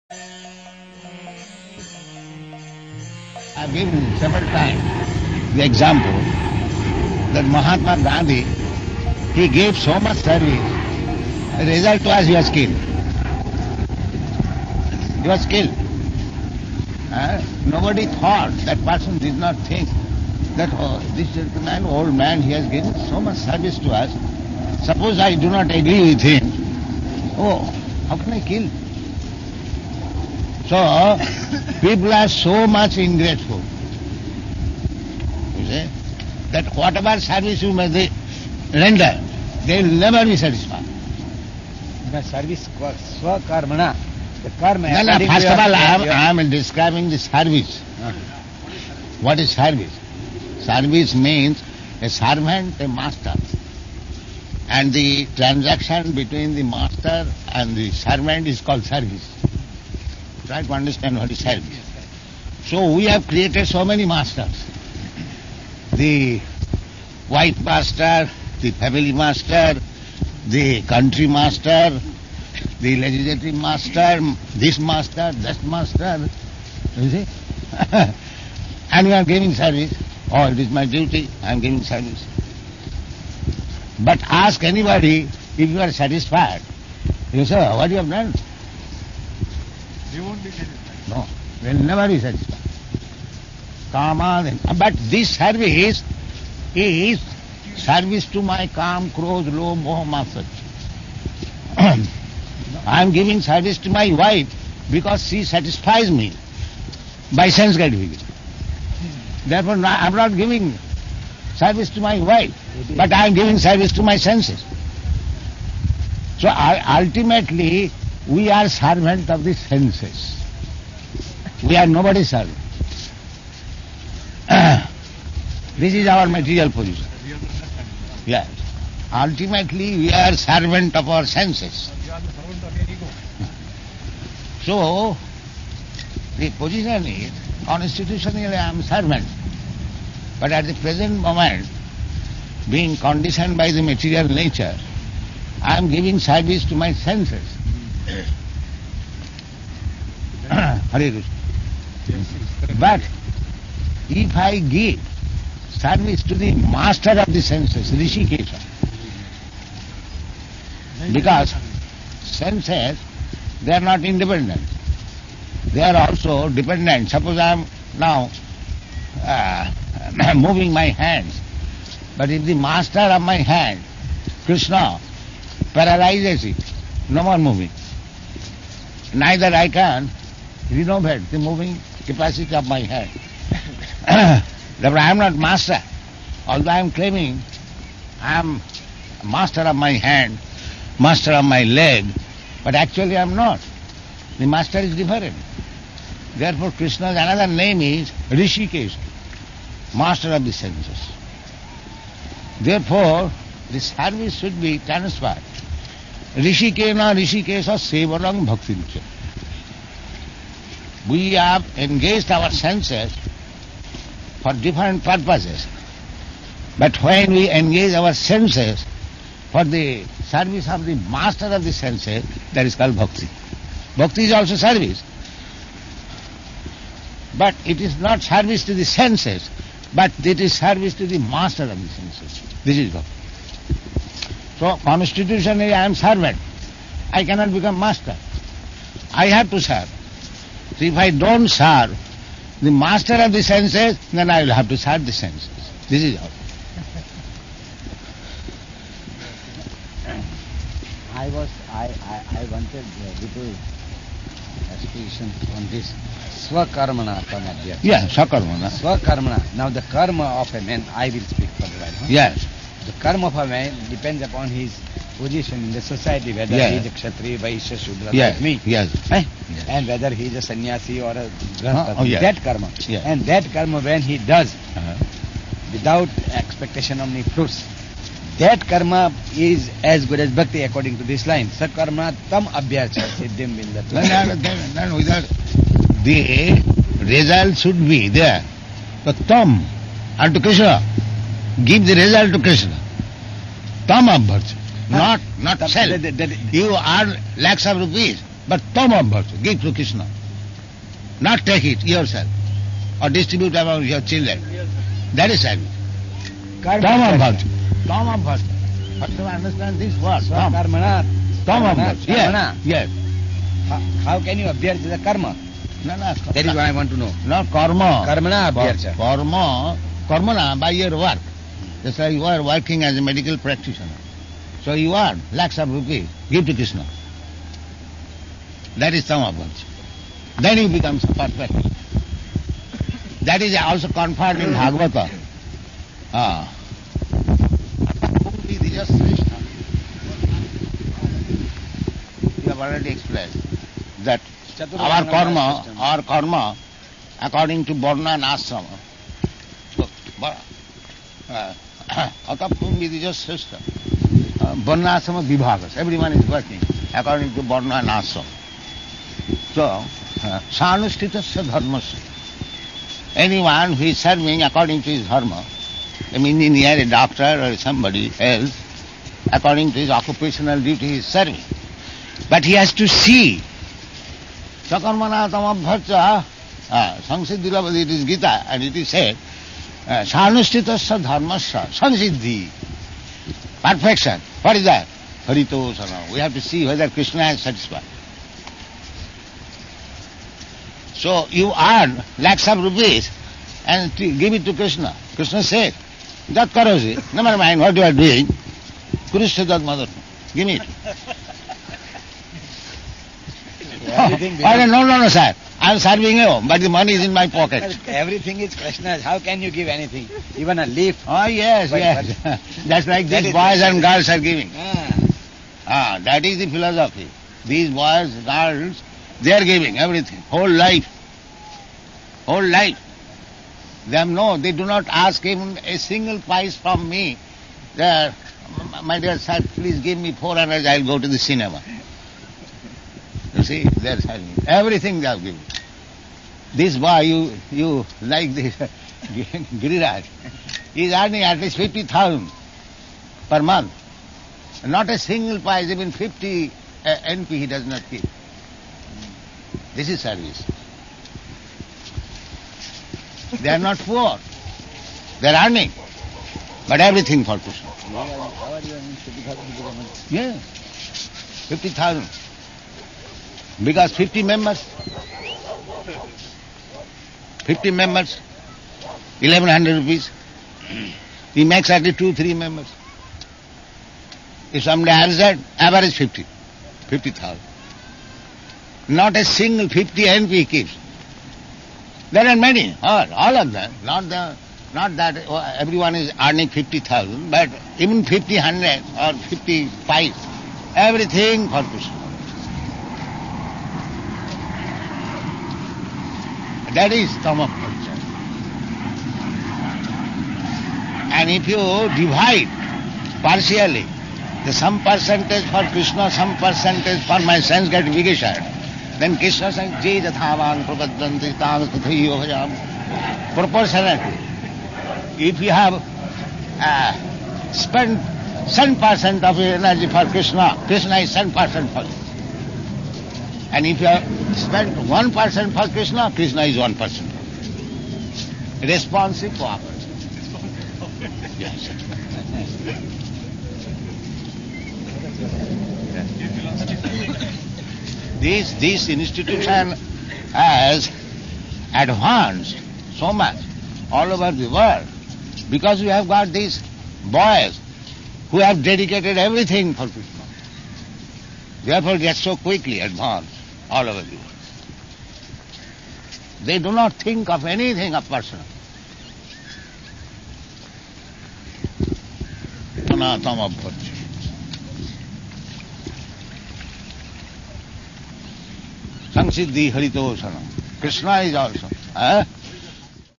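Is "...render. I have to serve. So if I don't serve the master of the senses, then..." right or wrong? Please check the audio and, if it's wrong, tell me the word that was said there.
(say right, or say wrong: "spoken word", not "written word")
wrong: "master", not "render".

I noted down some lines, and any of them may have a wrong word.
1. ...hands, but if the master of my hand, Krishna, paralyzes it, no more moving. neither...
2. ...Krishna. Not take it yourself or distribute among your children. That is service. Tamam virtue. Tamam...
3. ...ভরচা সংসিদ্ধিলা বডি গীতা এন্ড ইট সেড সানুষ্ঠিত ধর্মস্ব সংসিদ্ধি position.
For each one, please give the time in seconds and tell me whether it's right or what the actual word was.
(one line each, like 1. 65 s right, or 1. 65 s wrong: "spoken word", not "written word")
1. 170 s right
2. 299 s right
3. 375 s wrong: "perfection", not "position".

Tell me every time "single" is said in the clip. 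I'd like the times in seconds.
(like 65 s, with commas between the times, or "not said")
425 s, 444 s, 479 s.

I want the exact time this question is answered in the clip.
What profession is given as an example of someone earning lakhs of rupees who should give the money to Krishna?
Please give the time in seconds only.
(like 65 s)
323 s.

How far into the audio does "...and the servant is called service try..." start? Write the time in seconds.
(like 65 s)
57 s.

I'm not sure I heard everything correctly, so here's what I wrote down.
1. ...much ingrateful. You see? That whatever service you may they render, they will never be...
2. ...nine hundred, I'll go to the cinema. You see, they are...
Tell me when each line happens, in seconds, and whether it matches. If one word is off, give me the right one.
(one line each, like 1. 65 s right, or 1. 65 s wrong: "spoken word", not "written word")
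1. 32 s right
2. 430 s wrong: "four", not "nine".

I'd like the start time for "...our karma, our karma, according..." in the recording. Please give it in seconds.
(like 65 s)
344 s.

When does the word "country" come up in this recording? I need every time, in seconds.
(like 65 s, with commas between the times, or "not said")
70 s.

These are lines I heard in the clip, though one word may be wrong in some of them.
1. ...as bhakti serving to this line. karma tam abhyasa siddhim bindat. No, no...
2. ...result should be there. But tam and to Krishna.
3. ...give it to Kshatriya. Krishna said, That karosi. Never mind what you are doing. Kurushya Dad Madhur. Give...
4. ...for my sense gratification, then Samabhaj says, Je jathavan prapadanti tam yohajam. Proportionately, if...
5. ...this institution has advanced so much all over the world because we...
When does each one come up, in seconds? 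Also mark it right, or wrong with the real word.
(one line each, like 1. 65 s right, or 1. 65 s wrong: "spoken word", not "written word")
1. 280 s wrong: "according", not "serving"
2. 287 s right
3. 394 s wrong: "Krishna", not "Kshatriya"
4. 507 s wrong: "Krishna", not "Samabhaj"
5. 538 s right.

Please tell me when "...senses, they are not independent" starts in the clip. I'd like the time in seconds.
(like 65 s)
162 s.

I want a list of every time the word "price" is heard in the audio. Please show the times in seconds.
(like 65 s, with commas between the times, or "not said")
426 s, 445 s.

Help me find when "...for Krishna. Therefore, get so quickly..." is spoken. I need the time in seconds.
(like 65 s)
549 s.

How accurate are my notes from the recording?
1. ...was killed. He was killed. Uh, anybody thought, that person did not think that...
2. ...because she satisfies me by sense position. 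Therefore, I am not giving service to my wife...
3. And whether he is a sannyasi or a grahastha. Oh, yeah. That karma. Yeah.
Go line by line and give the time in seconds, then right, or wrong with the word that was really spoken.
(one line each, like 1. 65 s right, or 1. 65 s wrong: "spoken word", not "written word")
1. 12 s wrong: "nobody", not "anybody"
2. 104 s wrong: "gratification", not "position"
3. 269 s right.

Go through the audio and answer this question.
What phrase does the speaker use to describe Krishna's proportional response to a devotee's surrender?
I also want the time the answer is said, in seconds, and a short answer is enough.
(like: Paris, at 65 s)
Responsive cooperation, at 528 s.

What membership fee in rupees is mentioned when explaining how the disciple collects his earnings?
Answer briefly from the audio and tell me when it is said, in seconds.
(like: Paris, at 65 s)
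1100 rupees, at 469 s.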